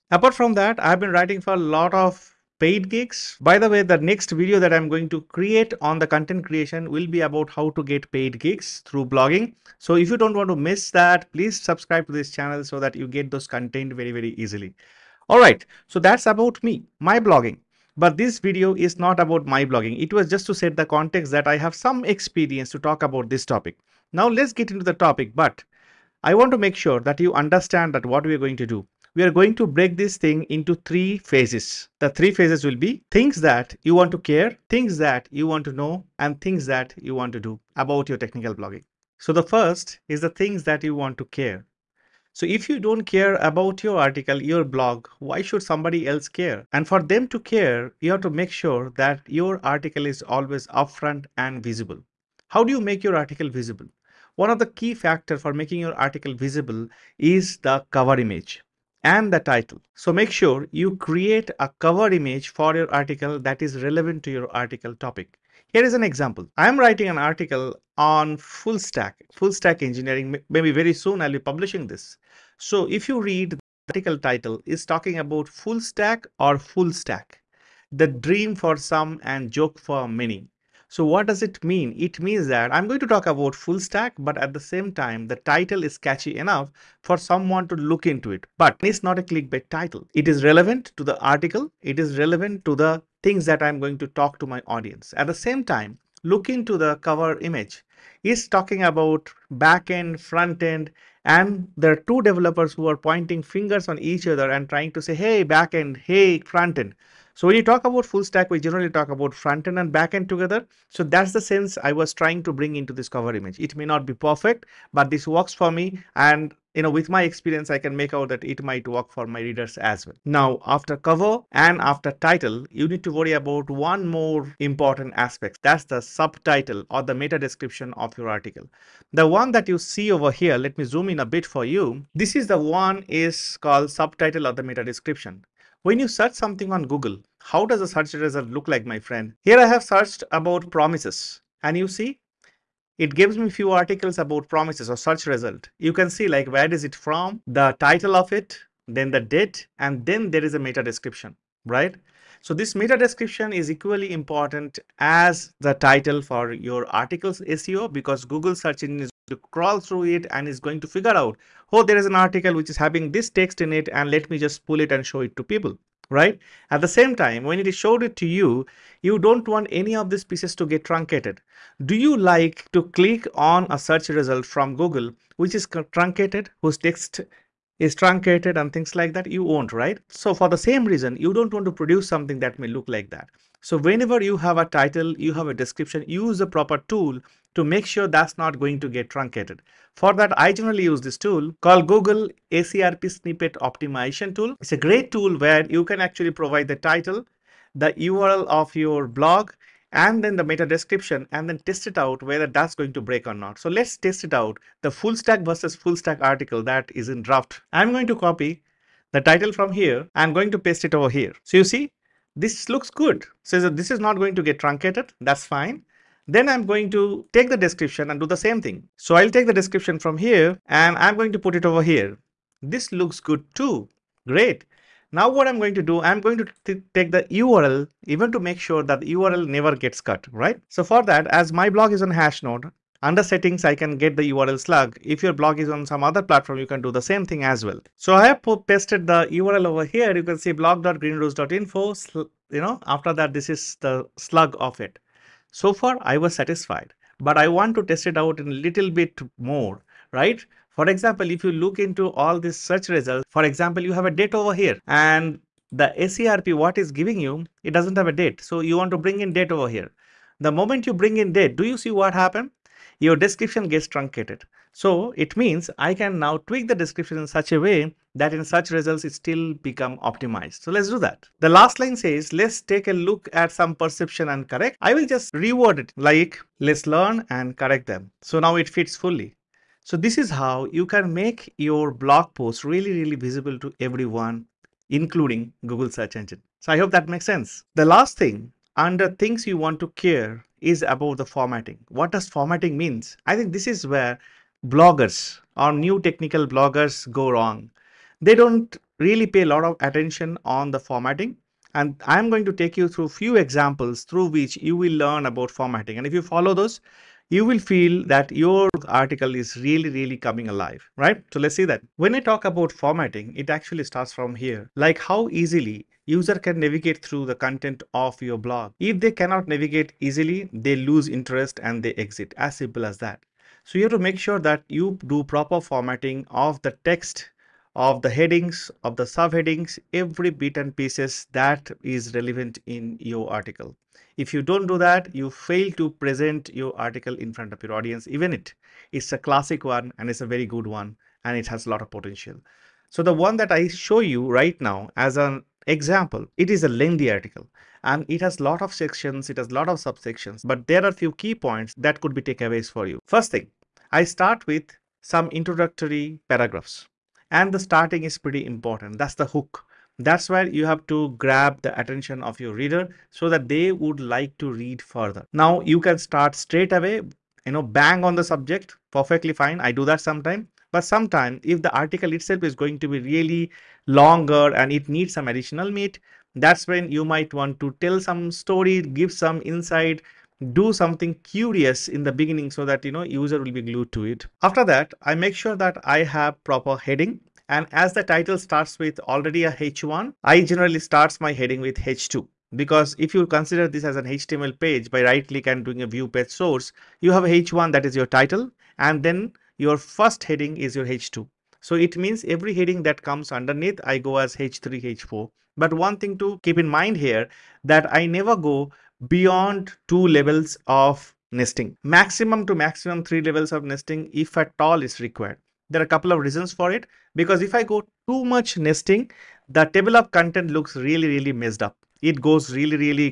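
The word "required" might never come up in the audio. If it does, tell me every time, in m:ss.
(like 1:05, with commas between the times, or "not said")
6:54.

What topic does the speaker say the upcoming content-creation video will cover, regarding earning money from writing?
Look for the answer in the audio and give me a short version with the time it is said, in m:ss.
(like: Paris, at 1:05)
How to get paid gigs through blogging, at 0:07.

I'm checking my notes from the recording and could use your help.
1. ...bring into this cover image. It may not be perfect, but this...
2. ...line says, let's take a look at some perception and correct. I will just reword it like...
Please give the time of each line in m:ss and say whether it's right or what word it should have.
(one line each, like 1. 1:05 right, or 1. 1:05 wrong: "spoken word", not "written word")
1. 1:52 right
2. 4:31 right.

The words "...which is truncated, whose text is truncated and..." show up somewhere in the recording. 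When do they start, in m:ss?
2:55.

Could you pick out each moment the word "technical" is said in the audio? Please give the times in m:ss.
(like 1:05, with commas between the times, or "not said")
0:38, 4:56.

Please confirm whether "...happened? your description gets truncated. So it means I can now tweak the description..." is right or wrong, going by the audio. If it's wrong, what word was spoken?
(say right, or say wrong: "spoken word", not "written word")
right.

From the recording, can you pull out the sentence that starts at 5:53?
First thing, I start with some introductory paragraphs and the starting is pretty important.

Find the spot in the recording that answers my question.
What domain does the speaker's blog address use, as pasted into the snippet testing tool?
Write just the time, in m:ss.
4:00.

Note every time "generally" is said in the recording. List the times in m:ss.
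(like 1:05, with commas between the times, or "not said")
1:48, 3:10, 6:30.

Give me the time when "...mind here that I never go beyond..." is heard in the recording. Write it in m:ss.
6:46.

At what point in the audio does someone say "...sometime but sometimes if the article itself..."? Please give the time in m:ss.
6:10.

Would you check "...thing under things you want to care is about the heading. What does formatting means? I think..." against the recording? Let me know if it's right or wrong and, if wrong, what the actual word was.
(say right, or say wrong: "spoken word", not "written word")
wrong: "formatting", not "heading".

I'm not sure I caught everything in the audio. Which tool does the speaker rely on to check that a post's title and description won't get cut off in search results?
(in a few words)
Google SERP Snippet Optimization Tool.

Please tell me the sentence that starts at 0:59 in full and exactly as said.
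So make sure you create a cover image for your article that is relevant to your article topic.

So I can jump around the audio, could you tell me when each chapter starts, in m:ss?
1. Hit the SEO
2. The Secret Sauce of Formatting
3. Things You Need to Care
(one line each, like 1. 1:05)
1. 2:18
2. 5:11
3. 0:38.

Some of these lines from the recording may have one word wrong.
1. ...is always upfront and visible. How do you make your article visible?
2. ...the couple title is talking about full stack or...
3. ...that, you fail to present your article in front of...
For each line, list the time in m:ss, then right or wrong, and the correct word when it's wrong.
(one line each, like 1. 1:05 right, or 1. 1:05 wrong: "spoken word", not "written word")
1. 0:50 right
2. 1:13 wrong: "article", not "couple"
3. 5:34 right.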